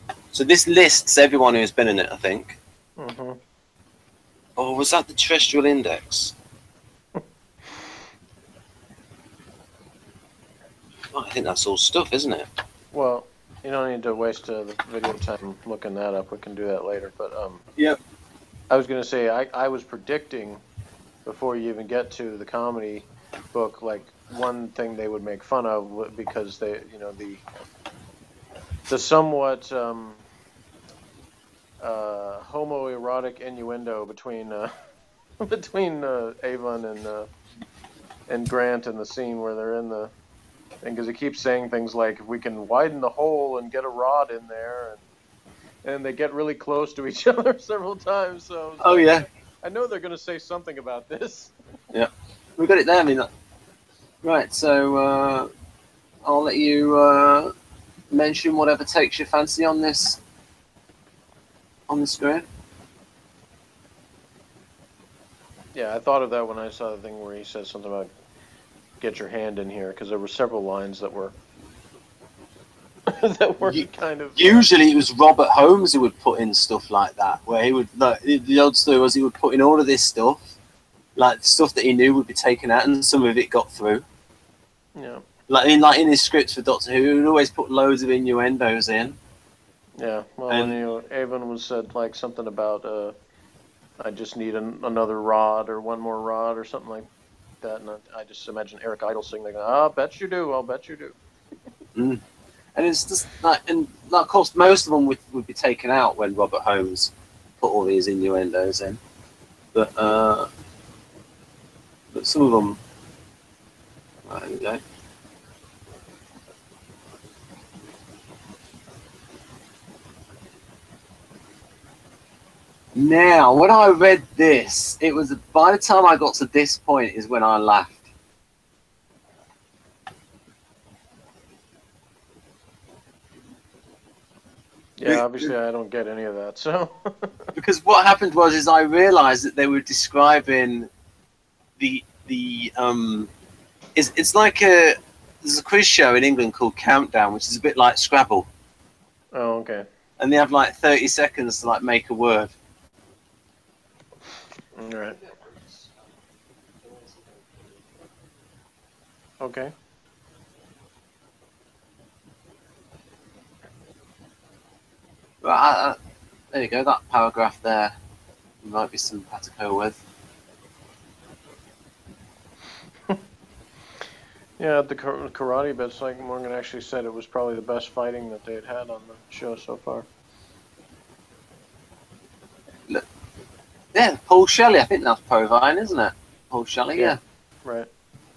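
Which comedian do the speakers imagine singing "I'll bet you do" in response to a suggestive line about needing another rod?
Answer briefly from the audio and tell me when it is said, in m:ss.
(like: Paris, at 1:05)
Eric Idle, at 1:38.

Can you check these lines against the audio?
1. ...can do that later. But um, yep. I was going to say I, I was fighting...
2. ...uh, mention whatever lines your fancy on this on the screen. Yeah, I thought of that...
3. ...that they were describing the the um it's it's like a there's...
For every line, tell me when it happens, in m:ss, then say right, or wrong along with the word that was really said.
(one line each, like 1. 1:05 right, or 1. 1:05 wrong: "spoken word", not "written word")
1. 0:16 wrong: "predicting", not "fighting"
2. 0:56 wrong: "takes", not "lines"
3. 2:19 right.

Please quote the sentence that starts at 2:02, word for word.
Now, when I read this, it was by the time I got to this point is when I laughed.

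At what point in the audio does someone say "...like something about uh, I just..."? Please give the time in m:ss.
1:31.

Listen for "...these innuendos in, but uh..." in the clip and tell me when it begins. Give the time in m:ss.
1:47.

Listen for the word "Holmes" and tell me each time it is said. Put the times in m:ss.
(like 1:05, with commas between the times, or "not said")
1:15, 1:46.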